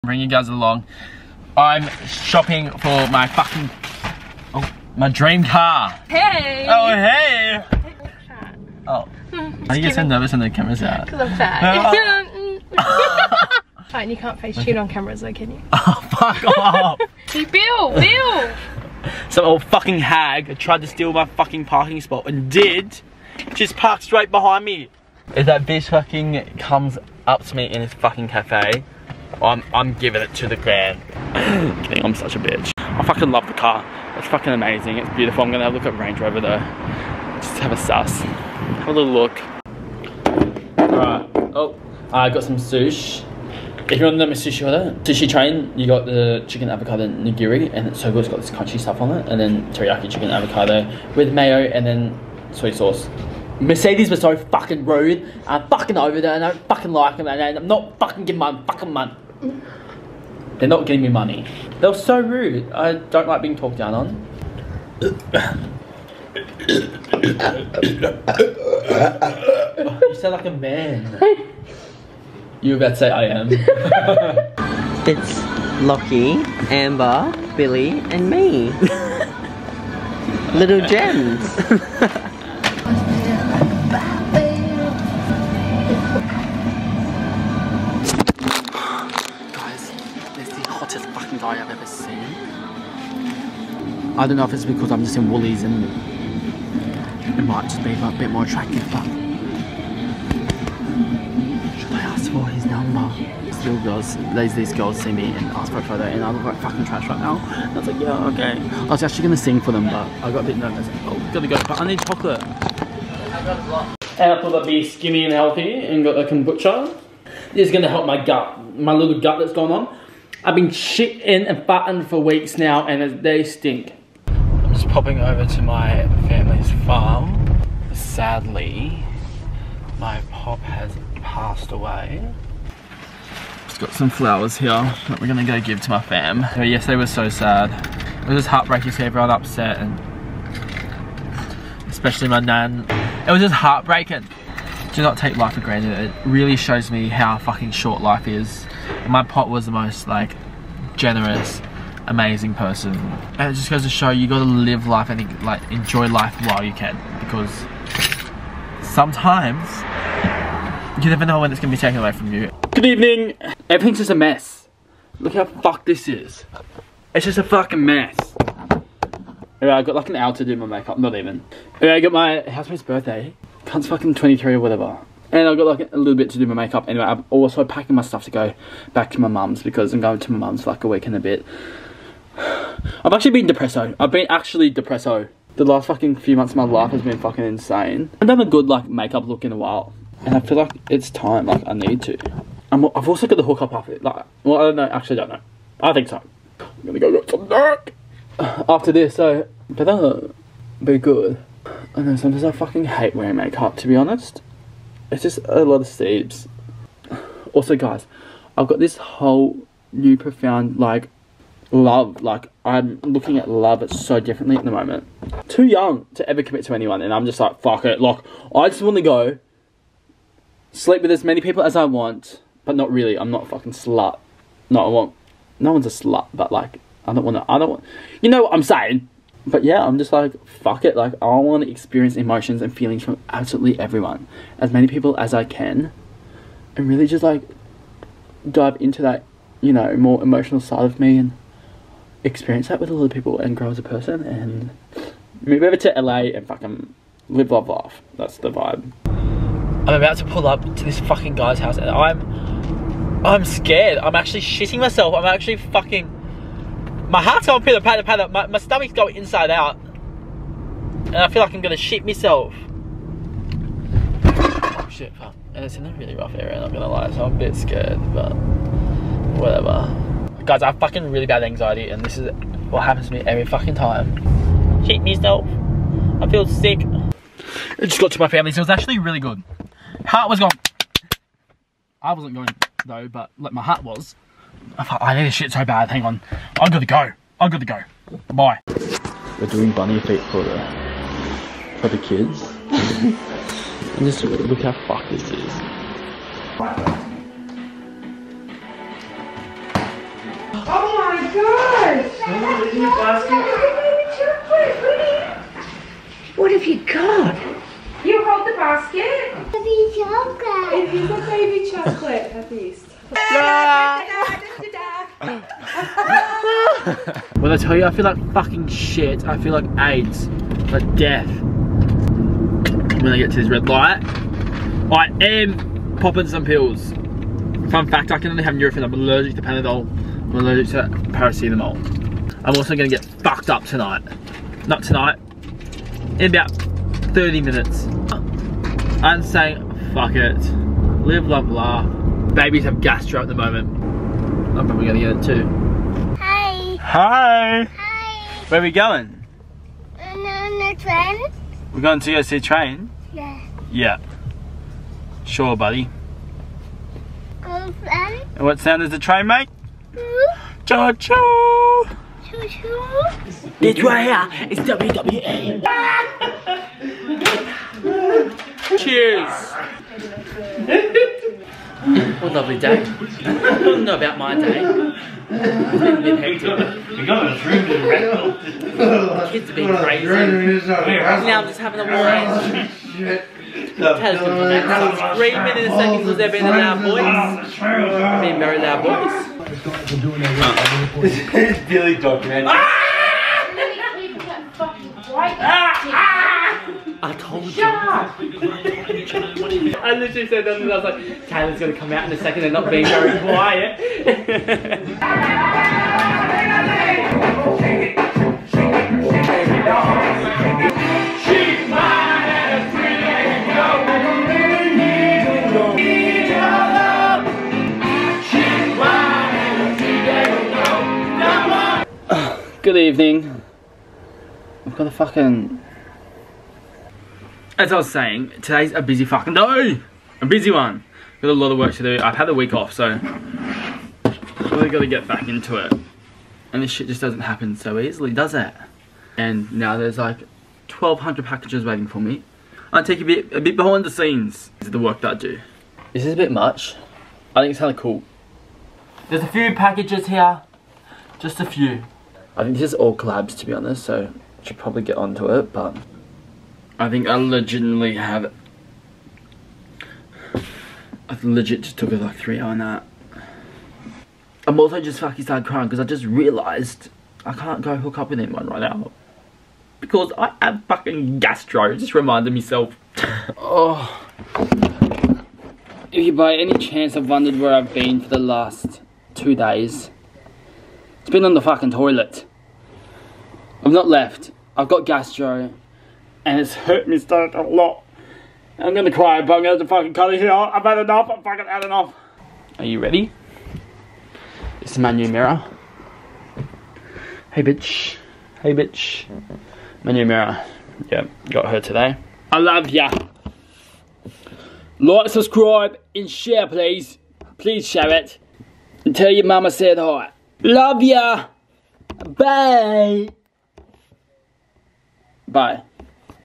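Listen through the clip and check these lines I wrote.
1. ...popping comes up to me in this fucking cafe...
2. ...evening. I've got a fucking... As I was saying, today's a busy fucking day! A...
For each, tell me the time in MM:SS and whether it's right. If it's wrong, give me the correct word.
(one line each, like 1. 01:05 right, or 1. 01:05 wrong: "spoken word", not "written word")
1. 00:25 wrong: "fucking", not "popping"
2. 07:02 right.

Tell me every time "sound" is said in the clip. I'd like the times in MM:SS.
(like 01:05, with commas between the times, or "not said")
01:10, 05:58.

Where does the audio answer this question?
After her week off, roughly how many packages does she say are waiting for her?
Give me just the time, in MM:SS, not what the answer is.
07:20.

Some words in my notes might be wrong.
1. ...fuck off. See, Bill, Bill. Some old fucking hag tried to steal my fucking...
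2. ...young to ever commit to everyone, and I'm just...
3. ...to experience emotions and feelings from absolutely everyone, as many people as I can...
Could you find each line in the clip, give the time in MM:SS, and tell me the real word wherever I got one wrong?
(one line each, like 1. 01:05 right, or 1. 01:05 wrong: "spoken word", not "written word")
1. 00:16 right
2. 03:35 wrong: "anyone", not "everyone"
3. 03:51 right.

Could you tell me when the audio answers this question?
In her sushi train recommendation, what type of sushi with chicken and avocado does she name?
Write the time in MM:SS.
00:47.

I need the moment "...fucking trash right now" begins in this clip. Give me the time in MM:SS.
01:46.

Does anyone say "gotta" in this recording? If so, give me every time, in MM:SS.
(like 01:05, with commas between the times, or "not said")
01:51, 02:34, 07:14.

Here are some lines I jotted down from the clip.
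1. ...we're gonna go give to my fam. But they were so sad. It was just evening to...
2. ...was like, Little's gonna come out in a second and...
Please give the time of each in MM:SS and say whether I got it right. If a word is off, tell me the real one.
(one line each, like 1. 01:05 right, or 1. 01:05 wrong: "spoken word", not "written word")
1. 02:15 wrong: "heartbreaking", not "evening"
2. 06:40 wrong: "Taylor", not "Little".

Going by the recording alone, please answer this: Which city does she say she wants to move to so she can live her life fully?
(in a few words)
LA.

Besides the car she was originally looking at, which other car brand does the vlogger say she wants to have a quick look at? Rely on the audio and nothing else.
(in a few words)
Range Rover.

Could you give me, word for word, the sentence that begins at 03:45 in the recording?
No one's a slut, but like I don't want to.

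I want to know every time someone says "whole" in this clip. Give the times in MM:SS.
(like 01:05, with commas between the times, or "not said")
03:28.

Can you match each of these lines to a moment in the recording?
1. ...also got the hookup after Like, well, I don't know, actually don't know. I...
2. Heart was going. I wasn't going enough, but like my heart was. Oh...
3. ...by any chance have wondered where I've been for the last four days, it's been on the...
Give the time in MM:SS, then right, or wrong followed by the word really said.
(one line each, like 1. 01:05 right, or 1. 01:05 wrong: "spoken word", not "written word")
1. 03:13 right
2. 04:40 wrong: "though", not "enough"
3. 07:56 wrong: "two", not "four".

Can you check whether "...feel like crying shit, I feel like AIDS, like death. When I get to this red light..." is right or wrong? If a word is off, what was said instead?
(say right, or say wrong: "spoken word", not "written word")
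wrong: "fucking", not "crying".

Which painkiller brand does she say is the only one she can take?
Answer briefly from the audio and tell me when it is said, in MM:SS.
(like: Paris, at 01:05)
Nurofen, at 05:28.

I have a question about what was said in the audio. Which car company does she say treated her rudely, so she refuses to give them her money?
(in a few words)
Mercedes.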